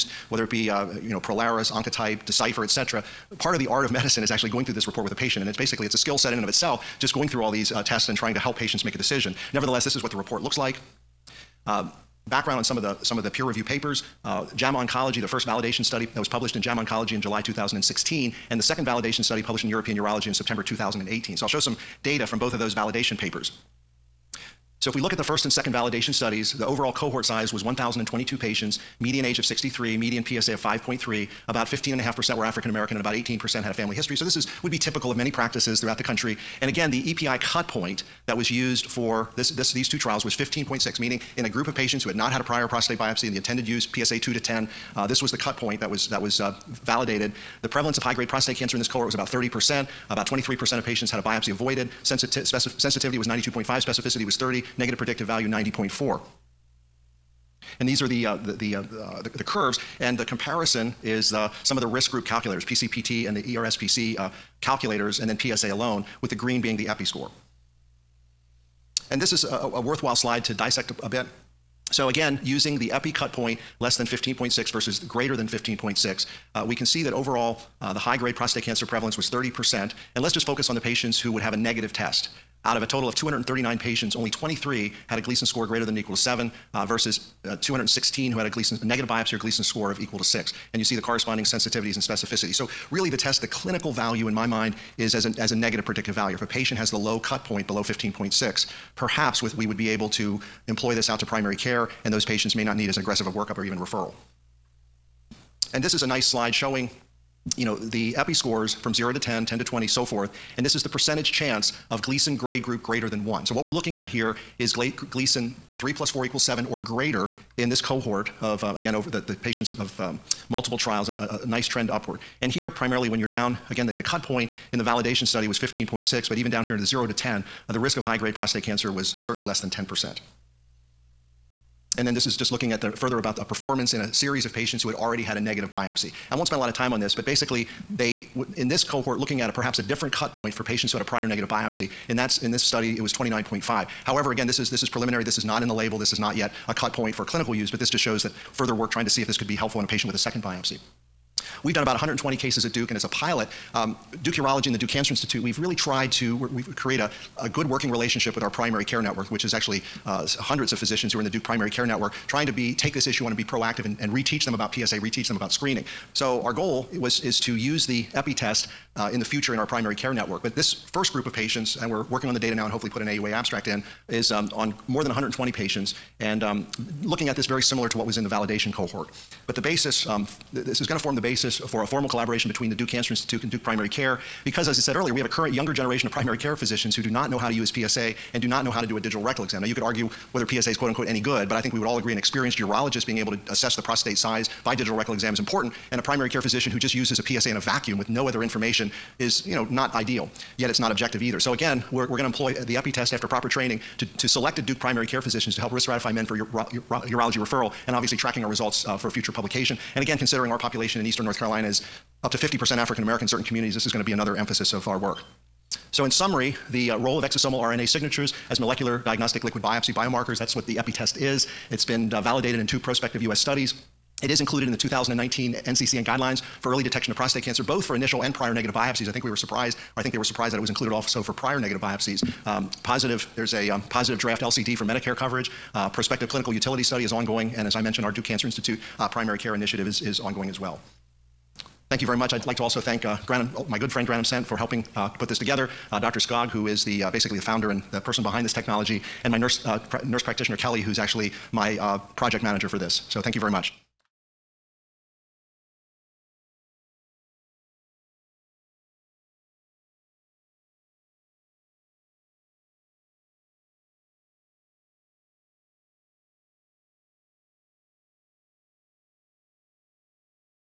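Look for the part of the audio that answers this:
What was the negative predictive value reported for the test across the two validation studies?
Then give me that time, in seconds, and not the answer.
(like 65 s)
55 s.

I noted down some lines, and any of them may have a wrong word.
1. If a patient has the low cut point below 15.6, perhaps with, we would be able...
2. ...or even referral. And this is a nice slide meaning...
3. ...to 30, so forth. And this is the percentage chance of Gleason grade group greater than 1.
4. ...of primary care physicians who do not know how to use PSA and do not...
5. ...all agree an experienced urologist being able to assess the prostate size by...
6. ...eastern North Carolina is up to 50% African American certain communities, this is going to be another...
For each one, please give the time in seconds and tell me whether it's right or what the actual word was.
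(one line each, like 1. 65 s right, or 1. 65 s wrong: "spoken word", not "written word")
1. 96 s right
2. 103 s wrong: "showing", not "meaning"
3. 109 s wrong: "20", not "30"
4. 186 s right
5. 191 s right
6. 211 s right.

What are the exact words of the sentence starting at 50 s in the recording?
About 23% of patients had a biopsy avoided.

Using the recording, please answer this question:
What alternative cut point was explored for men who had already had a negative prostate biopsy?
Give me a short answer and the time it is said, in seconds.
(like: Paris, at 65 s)
29.5, at 143 s.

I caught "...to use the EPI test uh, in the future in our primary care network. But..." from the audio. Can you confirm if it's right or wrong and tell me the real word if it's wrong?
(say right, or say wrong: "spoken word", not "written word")
right.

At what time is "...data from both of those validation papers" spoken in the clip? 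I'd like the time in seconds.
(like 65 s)
22 s.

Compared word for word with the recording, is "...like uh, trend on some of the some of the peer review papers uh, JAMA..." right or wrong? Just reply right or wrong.
wrong.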